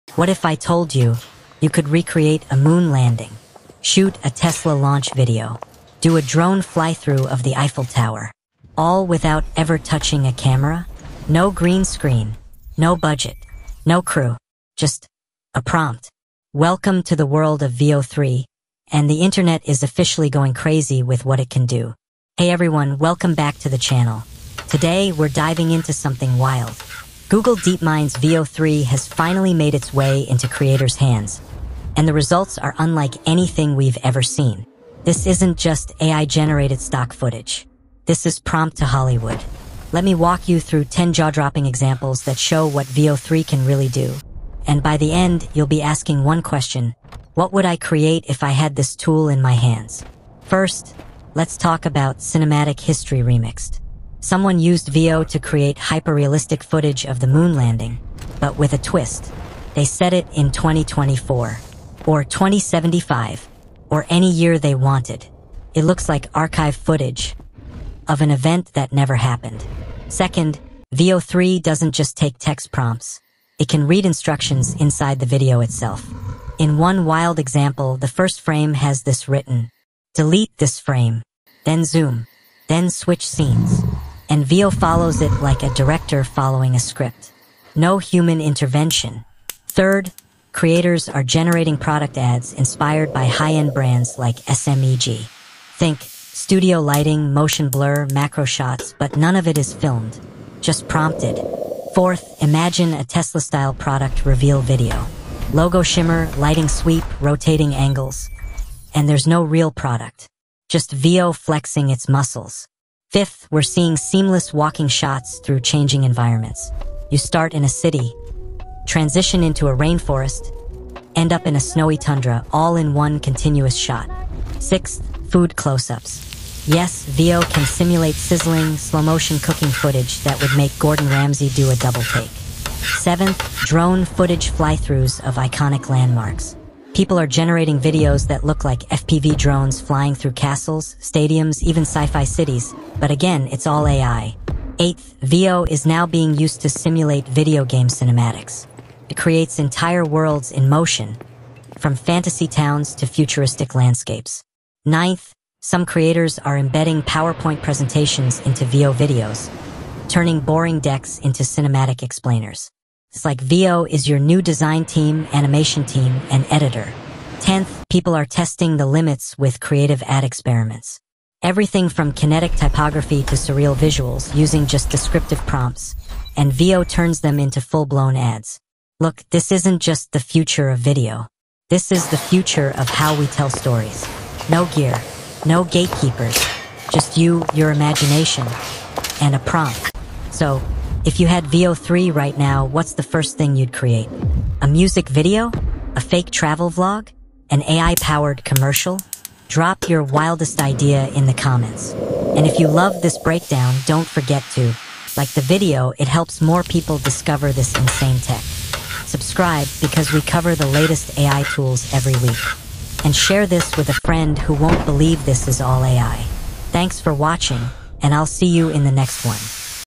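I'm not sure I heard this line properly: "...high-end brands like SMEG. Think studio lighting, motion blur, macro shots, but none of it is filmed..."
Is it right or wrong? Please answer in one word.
right.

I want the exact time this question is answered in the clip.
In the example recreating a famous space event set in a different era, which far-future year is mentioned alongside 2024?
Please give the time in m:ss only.
1:02.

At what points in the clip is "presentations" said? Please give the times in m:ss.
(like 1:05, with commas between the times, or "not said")
2:37.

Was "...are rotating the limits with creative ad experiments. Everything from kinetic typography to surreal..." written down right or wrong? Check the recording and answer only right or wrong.
wrong.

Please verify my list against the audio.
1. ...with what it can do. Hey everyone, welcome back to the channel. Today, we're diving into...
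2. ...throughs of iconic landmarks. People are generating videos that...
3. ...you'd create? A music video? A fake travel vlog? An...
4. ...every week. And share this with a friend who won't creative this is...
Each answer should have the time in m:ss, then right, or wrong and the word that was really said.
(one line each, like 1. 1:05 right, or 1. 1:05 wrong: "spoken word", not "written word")
1. 0:21 right
2. 2:14 right
3. 3:13 right
4. 3:31 wrong: "believe", not "creative".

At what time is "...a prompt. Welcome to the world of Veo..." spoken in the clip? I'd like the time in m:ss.
0:15.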